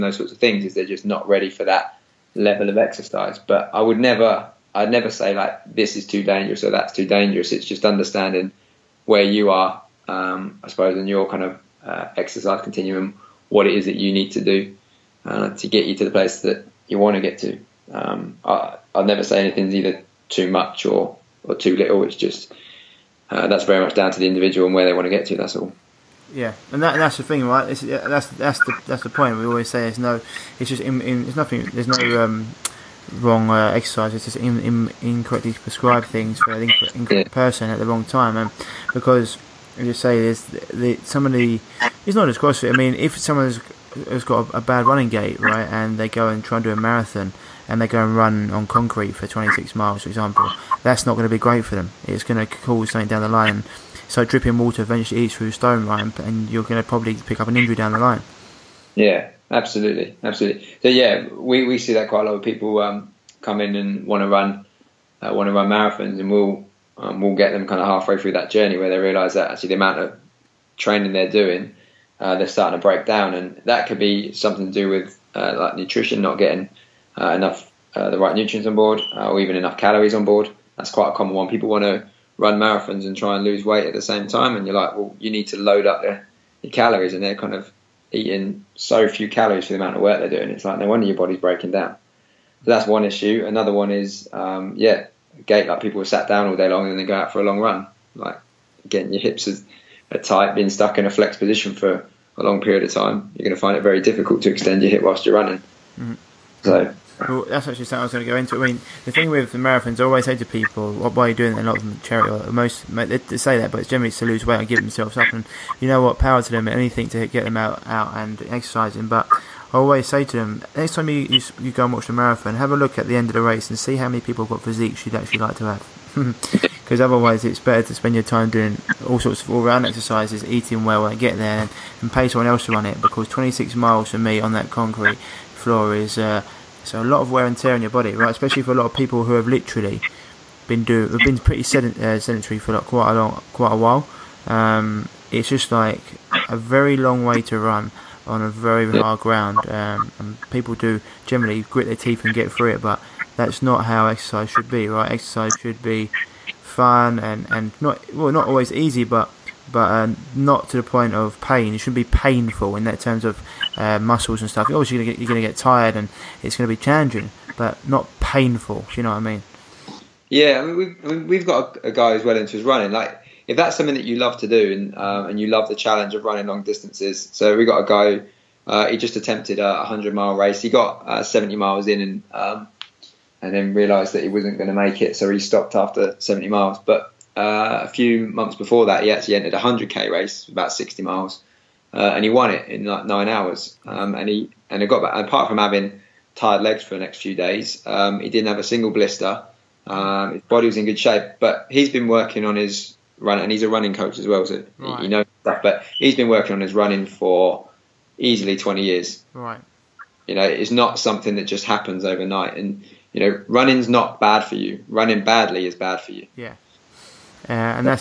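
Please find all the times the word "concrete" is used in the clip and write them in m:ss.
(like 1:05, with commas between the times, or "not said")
0:48, 2:14.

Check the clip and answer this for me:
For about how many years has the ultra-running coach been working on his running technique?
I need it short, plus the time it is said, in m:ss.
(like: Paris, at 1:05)
20 years, at 3:28.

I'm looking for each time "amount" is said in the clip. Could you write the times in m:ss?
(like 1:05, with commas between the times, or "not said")
1:09, 1:29.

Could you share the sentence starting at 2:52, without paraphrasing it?
Like if that's something that you love to do and um, and you love the challenge of running long distances.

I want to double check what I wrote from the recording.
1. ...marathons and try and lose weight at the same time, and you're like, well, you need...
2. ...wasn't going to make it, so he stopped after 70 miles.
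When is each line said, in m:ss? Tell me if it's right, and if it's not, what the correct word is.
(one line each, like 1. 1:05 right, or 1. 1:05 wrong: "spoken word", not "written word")
1. 1:22 right
2. 3:04 right.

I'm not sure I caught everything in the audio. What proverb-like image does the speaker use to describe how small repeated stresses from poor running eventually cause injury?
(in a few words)
dripping water eventually eats through stone.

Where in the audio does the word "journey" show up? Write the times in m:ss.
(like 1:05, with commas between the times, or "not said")
1:08.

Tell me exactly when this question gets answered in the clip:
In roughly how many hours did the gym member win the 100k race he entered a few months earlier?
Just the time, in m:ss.
3:13.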